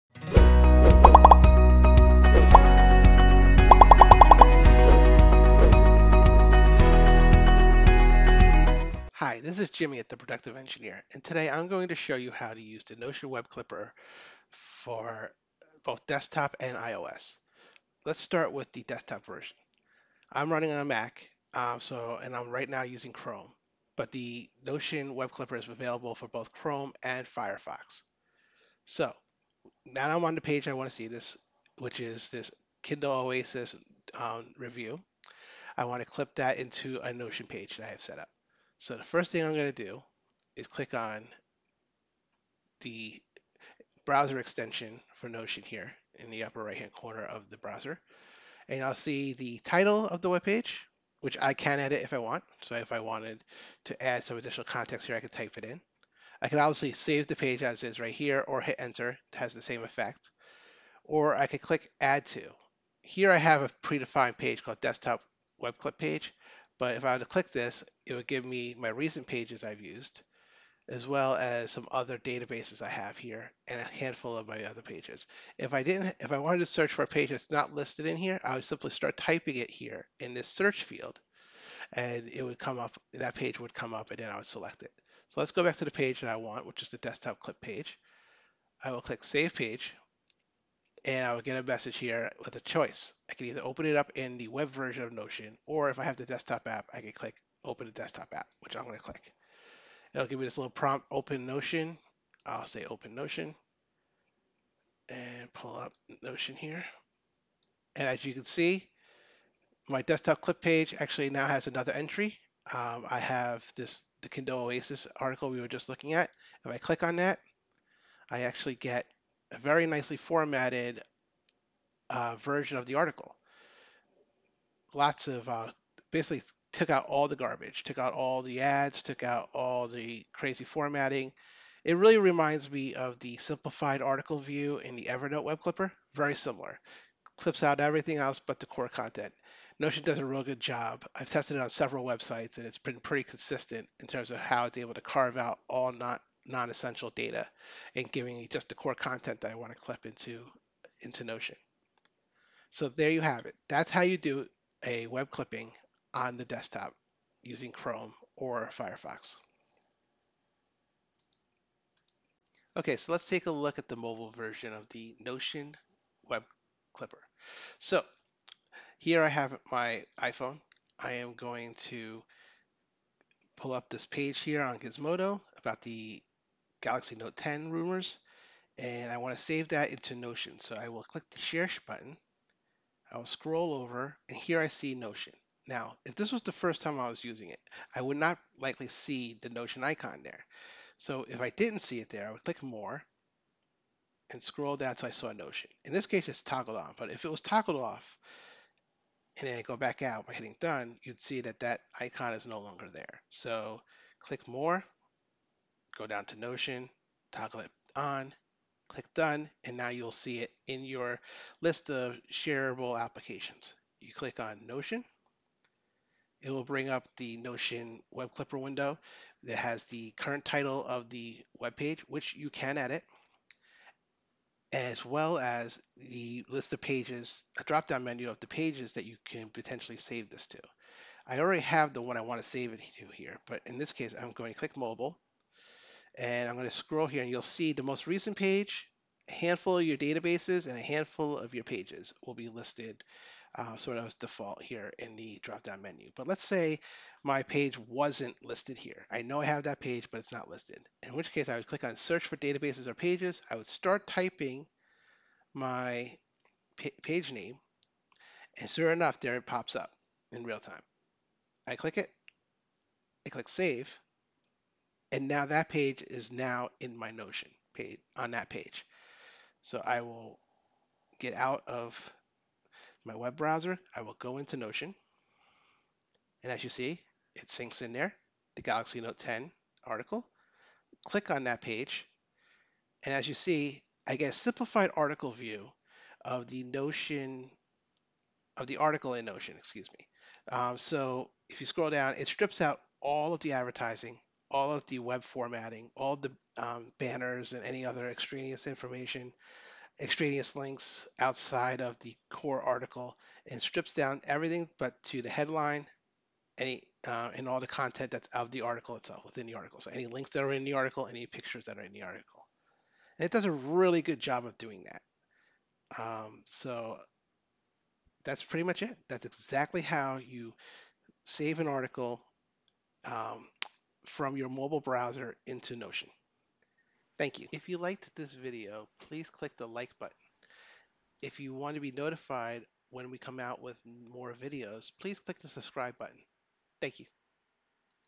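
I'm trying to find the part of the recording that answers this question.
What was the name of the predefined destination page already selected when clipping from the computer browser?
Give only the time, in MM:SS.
01:04.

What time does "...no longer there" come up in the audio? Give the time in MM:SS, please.
03:22.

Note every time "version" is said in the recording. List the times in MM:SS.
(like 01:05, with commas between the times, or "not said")
00:19, 01:34, 02:02, 02:44.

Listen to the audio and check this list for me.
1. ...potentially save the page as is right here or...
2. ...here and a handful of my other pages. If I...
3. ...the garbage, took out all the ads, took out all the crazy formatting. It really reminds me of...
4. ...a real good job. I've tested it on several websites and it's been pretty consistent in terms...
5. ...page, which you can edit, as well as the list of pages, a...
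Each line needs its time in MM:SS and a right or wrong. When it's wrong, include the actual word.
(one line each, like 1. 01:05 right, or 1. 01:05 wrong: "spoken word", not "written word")
1. 00:56 wrong: "obviously", not "potentially"
2. 01:13 right
3. 02:07 right
4. 02:20 right
5. 03:41 right.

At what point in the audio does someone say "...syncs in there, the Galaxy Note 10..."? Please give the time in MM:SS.
04:37.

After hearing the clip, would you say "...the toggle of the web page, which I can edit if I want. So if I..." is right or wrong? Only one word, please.
wrong.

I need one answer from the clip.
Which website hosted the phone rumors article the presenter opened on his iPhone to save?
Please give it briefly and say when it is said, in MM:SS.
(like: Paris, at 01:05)
Gizmodo, at 02:54.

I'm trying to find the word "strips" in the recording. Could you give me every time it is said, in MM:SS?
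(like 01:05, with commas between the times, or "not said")
04:52, 05:03.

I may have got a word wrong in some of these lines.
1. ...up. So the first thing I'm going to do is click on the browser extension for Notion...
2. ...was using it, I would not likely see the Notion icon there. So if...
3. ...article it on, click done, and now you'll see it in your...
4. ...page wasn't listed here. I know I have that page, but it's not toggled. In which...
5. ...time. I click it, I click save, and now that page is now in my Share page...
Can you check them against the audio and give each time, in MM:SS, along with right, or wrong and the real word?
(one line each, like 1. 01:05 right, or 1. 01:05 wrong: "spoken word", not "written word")
1. 00:38 right
2. 03:07 right
3. 03:27 wrong: "toggle", not "article"
4. 04:07 wrong: "listed", not "toggled"
5. 04:20 wrong: "Notion", not "Share".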